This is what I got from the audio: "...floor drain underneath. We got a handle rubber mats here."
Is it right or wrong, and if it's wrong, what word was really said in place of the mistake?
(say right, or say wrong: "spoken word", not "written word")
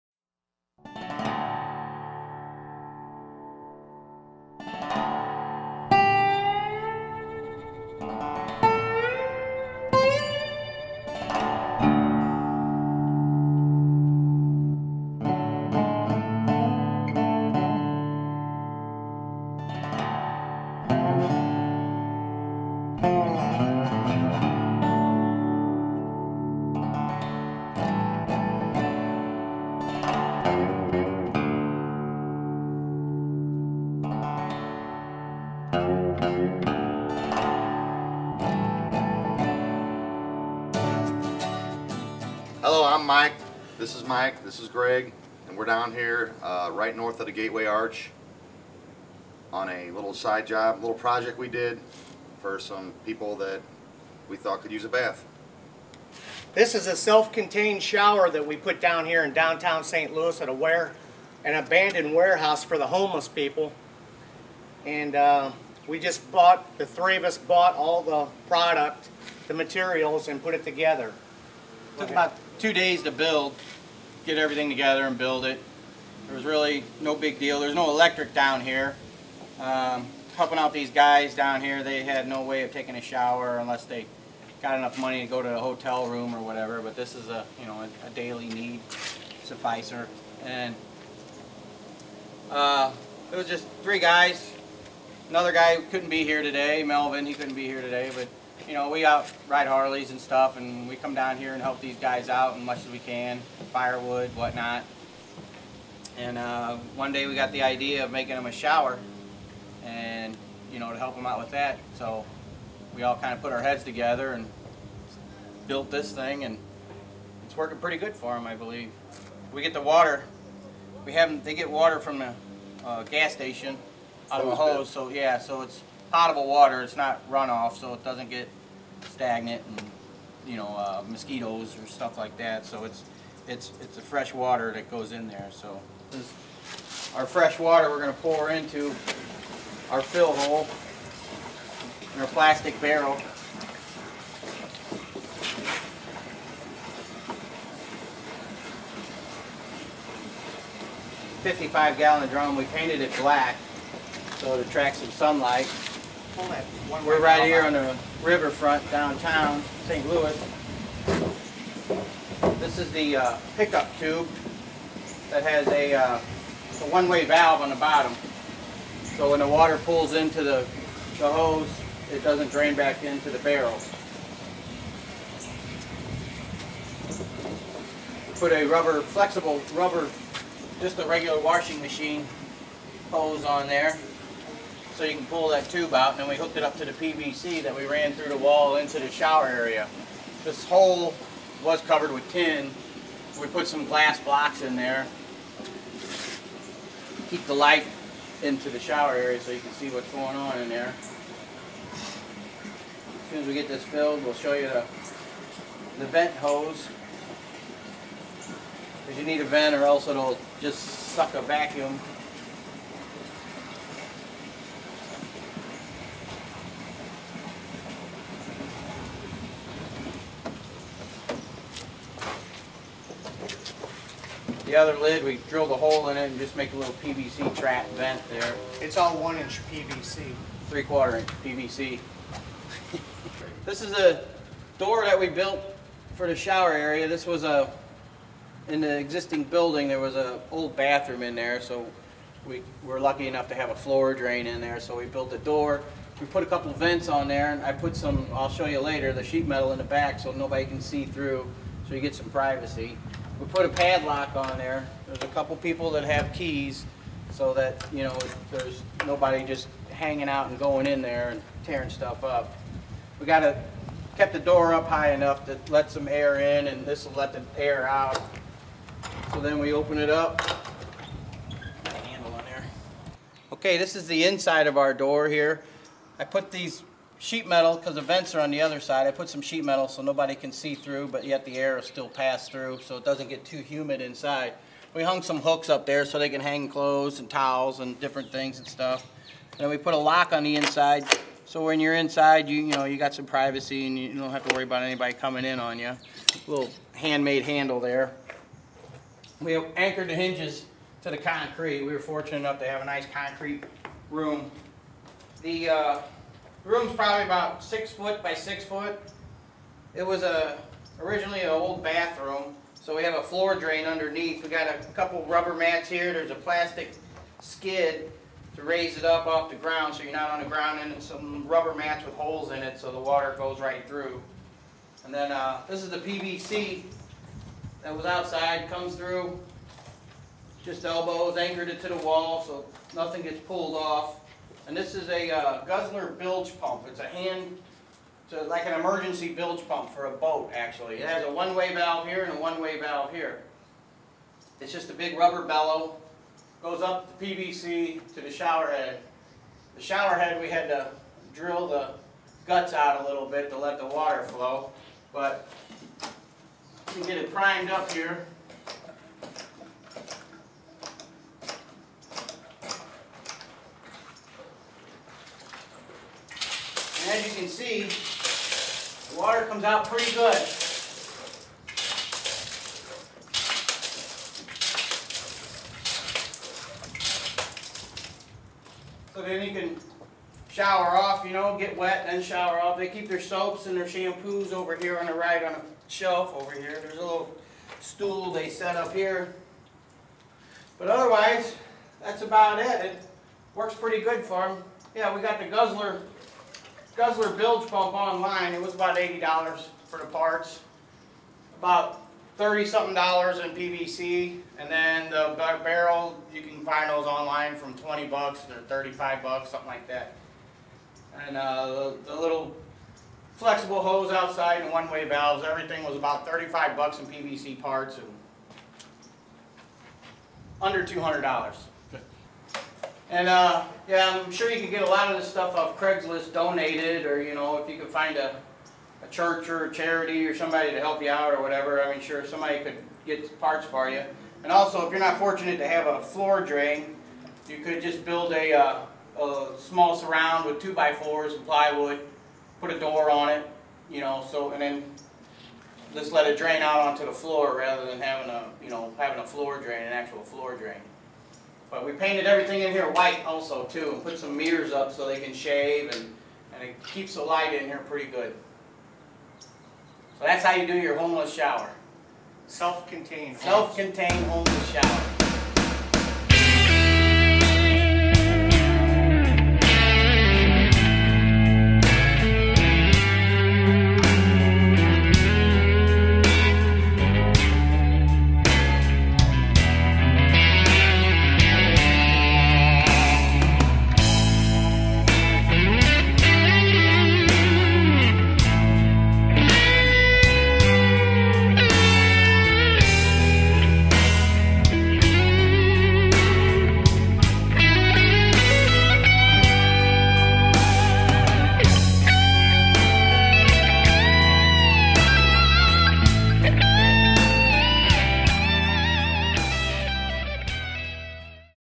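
wrong: "couple", not "handle".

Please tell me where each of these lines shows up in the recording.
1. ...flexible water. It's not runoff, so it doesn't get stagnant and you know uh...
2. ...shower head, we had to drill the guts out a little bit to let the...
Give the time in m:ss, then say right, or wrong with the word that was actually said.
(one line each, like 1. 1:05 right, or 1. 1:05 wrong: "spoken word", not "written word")
1. 2:06 wrong: "potable", not "flexible"
2. 5:49 right.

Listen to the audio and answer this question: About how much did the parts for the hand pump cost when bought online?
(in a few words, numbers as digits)
$80.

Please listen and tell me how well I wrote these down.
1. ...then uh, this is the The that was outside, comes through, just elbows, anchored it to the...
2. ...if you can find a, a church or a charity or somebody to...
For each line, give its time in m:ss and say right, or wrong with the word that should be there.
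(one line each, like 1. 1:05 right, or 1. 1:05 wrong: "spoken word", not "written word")
1. 5:25 wrong: "PVC", not "The"
2. 7:07 right.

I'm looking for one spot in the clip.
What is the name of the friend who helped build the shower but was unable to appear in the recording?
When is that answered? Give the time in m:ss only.
1:36.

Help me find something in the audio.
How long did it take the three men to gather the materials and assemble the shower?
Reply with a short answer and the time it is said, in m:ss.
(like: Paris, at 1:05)
2 days, at 1:12.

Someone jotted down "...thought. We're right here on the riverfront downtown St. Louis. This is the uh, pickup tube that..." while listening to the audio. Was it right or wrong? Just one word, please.
wrong.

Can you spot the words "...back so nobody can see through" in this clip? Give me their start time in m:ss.
4:09.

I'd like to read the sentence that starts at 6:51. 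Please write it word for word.
And uh, the, the little flexible hose outside and one-way valves, everything was about 35 bucks in PVC parts and under $200.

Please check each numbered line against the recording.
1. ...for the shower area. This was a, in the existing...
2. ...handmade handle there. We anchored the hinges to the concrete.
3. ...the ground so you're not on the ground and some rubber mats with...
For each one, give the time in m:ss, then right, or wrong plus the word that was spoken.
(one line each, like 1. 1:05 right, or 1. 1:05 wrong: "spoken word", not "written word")
1. 3:56 right
2. 4:56 right
3. 5:19 right.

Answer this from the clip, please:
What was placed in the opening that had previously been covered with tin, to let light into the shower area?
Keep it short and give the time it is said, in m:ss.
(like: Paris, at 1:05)
glass blocks, at 3:13.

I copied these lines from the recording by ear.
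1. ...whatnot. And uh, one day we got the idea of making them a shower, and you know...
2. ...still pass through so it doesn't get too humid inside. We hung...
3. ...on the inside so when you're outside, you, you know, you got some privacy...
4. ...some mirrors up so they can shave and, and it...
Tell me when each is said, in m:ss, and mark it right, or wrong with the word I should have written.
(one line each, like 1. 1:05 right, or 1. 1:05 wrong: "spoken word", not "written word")
1. 1:44 right
2. 4:41 right
3. 4:50 wrong: "inside", not "outside"
4. 7:34 right.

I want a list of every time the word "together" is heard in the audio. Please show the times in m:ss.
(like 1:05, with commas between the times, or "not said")
1:10, 1:14, 1:53.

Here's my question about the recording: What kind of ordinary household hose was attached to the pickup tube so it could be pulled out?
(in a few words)
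washing machine hose.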